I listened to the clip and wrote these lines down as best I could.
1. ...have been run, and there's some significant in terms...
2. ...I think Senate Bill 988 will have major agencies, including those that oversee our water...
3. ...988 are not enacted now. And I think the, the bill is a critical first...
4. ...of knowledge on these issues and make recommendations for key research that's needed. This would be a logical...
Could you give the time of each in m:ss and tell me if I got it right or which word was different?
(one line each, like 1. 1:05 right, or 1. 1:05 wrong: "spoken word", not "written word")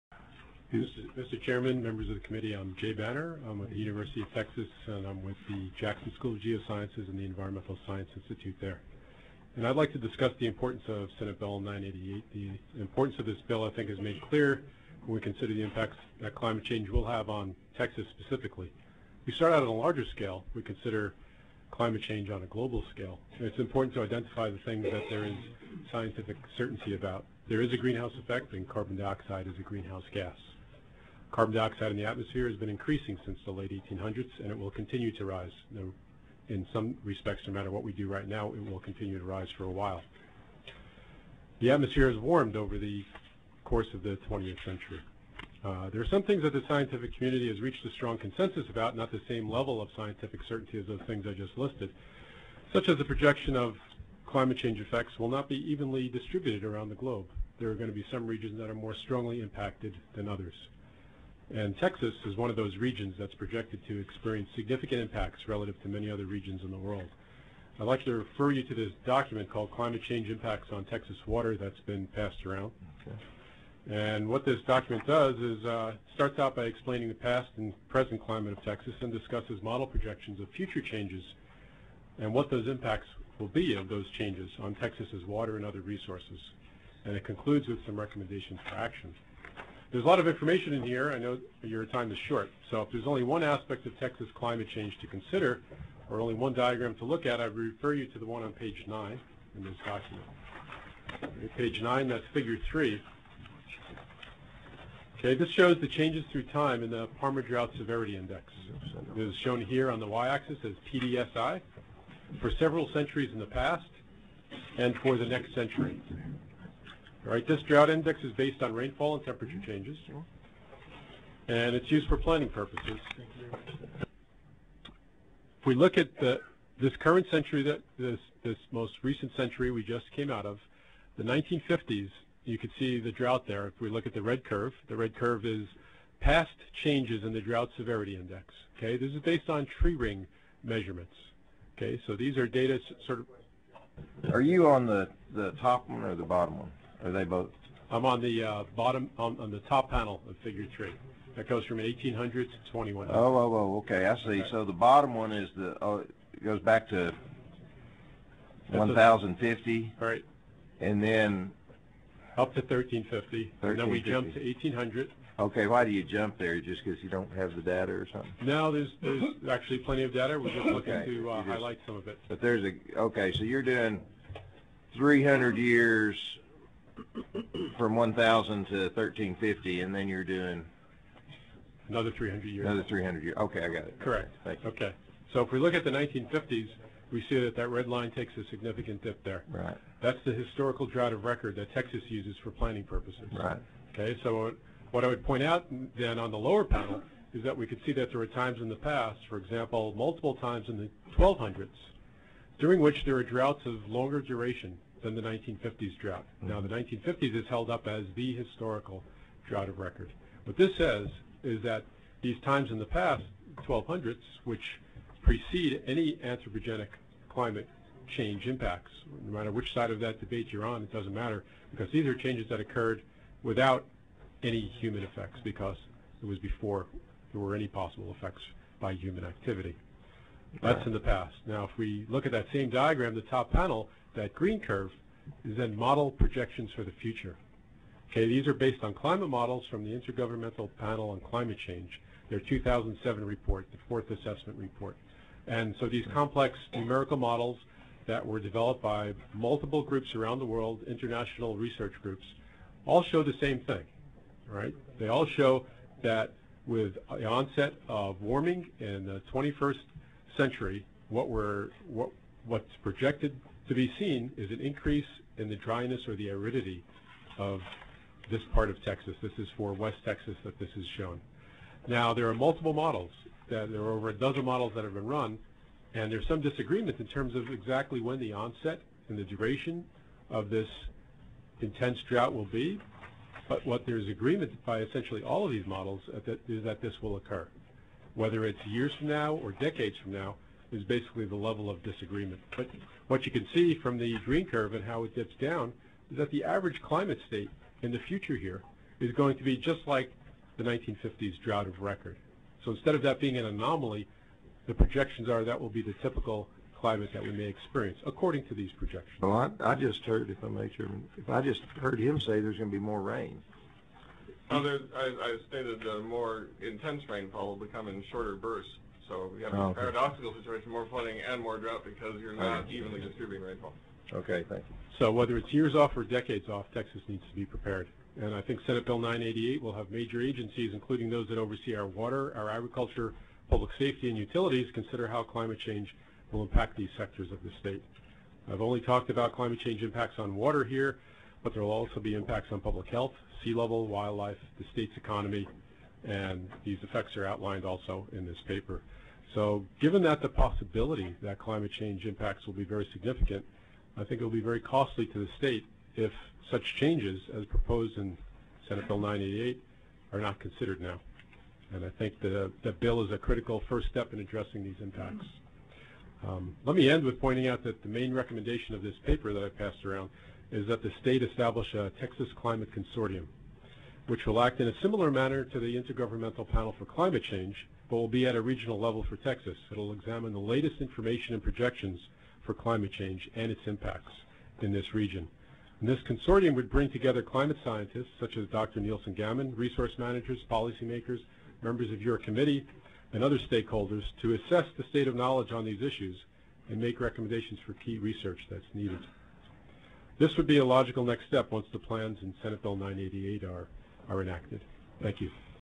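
1. 4:34 wrong: "disagreement", not "significant"
2. 5:28 right
3. 5:58 wrong: "considered", not "enacted"
4. 6:35 right.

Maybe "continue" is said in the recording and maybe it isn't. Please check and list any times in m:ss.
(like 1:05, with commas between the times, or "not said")
0:34, 0:38.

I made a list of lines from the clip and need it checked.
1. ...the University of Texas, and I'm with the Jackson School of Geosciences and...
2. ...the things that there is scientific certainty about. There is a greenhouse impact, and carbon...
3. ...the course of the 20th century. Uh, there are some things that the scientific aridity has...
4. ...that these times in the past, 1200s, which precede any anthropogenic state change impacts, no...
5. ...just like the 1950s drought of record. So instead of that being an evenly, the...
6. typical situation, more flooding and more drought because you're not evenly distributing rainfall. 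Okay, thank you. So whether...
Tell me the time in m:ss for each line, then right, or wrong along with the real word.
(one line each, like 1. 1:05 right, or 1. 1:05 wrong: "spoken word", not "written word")
1. 0:03 right
2. 0:24 wrong: "effect", not "impact"
3. 0:42 wrong: "community", not "aridity"
4. 3:31 wrong: "climate", not "state"
5. 4:59 wrong: "anomaly", not "evenly"
6. 5:19 wrong: "paradoxical", not "typical".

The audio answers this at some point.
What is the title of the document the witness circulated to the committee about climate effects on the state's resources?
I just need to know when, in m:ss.
1:09.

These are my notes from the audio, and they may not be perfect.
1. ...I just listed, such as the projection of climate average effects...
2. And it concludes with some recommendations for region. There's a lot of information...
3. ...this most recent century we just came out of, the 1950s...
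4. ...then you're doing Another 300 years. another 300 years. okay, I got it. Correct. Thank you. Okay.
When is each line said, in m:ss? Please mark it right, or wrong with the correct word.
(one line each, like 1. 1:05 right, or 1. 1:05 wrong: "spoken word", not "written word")
1. 0:51 wrong: "change", not "average"
2. 1:27 wrong: "action", not "region"
3. 2:08 right
4. 2:59 right.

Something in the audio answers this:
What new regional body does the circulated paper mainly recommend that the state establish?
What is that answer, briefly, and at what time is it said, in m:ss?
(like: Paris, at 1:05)
Texas Climate Consortium, at 6:11.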